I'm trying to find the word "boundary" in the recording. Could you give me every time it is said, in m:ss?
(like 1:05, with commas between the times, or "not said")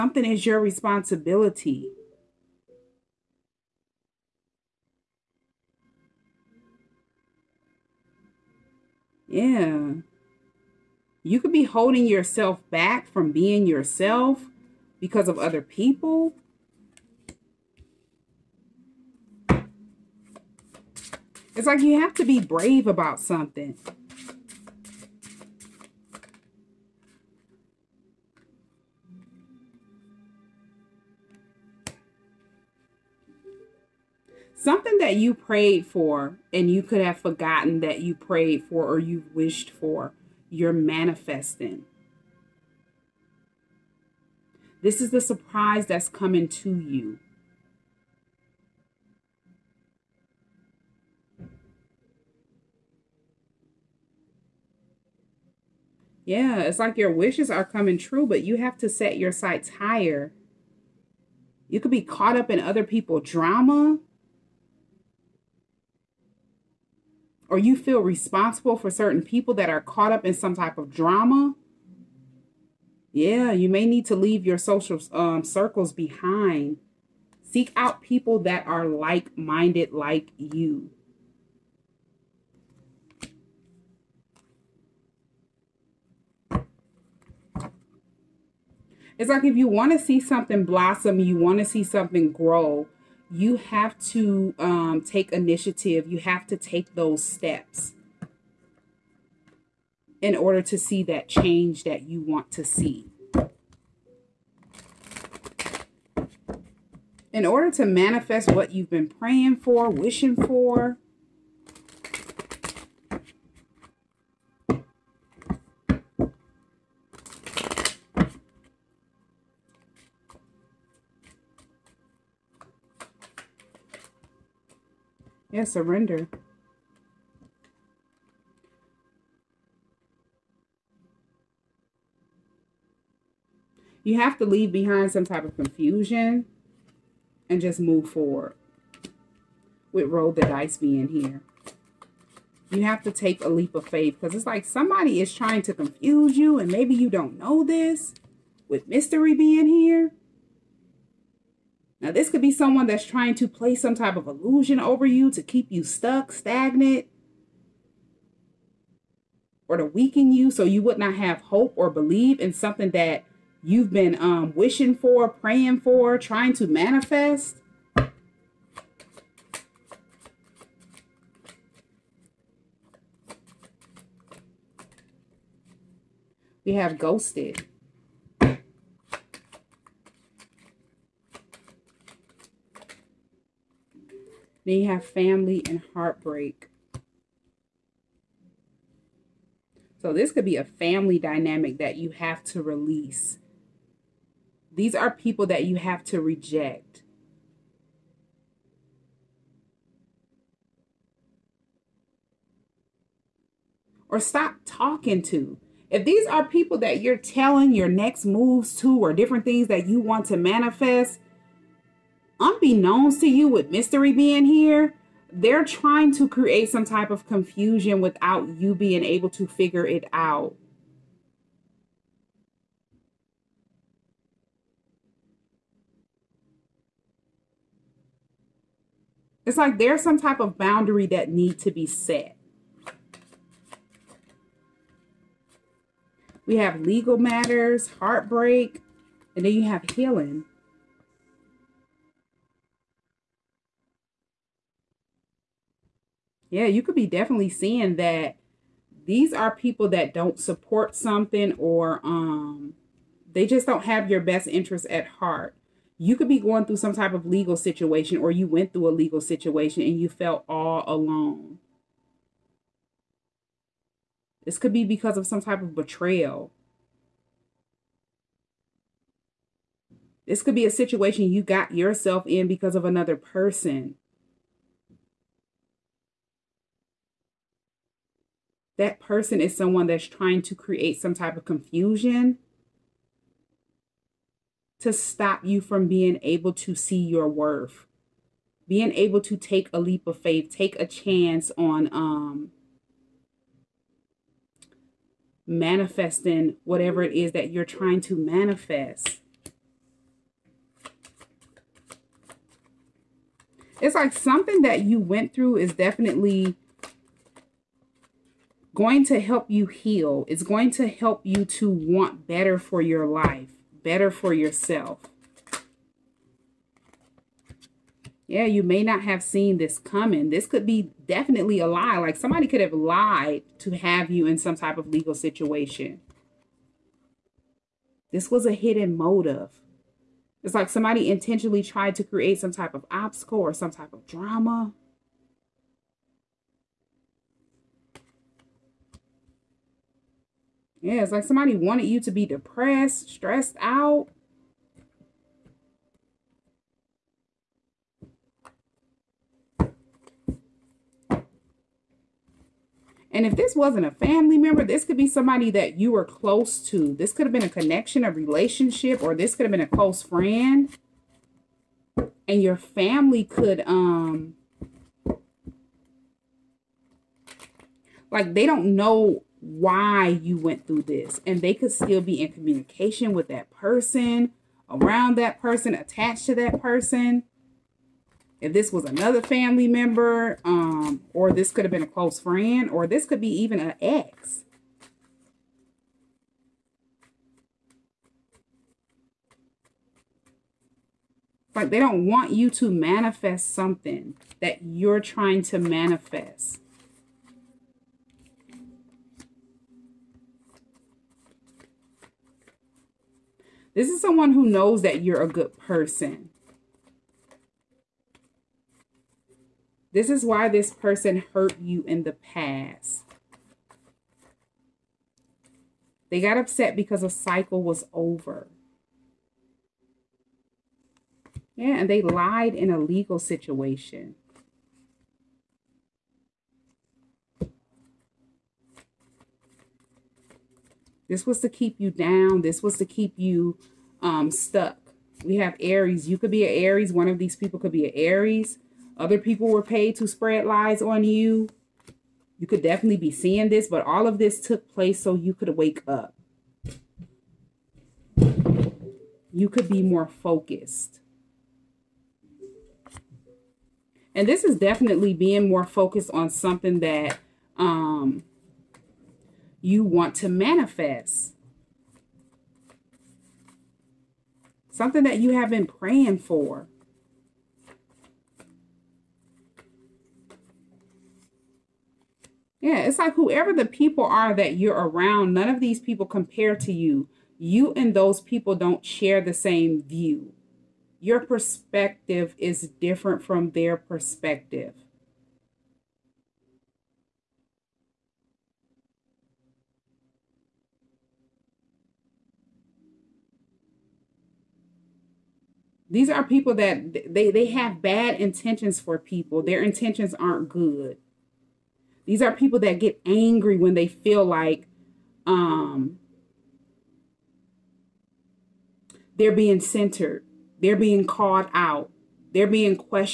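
3:50.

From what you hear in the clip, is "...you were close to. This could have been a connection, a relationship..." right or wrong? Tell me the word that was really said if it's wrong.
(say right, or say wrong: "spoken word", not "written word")
right.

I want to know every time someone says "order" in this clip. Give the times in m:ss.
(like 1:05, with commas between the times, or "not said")
1:40, 1:47.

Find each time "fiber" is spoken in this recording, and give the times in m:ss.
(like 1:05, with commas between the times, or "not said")
not said.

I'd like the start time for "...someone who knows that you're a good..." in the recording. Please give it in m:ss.
6:43.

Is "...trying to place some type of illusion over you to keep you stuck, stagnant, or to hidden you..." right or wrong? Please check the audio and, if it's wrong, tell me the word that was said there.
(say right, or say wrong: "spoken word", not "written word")
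wrong: "weaken", not "hidden".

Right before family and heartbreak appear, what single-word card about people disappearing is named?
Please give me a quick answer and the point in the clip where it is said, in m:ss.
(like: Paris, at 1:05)
Ghosted, at 2:56.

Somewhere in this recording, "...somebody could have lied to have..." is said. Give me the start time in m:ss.
5:22.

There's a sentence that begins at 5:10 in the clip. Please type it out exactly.
It's going to help you to want better for your life, better for yourself.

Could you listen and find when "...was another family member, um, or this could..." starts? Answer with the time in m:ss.
6:18.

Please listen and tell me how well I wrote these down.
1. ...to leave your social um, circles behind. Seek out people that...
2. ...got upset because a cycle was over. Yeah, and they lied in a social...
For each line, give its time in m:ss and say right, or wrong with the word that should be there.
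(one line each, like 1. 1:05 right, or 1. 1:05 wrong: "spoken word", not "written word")
1. 1:14 right
2. 6:56 wrong: "legal", not "social".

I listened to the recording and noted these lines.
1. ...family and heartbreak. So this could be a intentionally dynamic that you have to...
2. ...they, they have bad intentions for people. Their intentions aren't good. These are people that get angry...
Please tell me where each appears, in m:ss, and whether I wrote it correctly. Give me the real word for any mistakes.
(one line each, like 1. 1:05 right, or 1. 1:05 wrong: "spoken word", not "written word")
1. 3:05 wrong: "family", not "intentionally"
2. 8:17 right.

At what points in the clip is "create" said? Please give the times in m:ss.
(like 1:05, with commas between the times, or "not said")
3:36, 4:40, 5:32.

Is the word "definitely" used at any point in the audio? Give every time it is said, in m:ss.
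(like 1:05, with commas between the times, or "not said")
4:07, 5:05, 5:21, 7:22, 7:34.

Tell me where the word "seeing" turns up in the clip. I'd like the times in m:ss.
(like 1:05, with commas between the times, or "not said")
4:07, 7:23.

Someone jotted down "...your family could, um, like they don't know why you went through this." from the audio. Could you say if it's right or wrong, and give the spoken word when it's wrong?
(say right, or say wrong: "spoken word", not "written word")
right.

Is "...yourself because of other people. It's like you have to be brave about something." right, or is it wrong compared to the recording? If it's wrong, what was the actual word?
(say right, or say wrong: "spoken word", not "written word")
right.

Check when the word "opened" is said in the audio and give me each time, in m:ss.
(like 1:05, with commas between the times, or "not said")
not said.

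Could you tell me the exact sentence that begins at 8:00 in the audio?
Your perspective is different from their perspective.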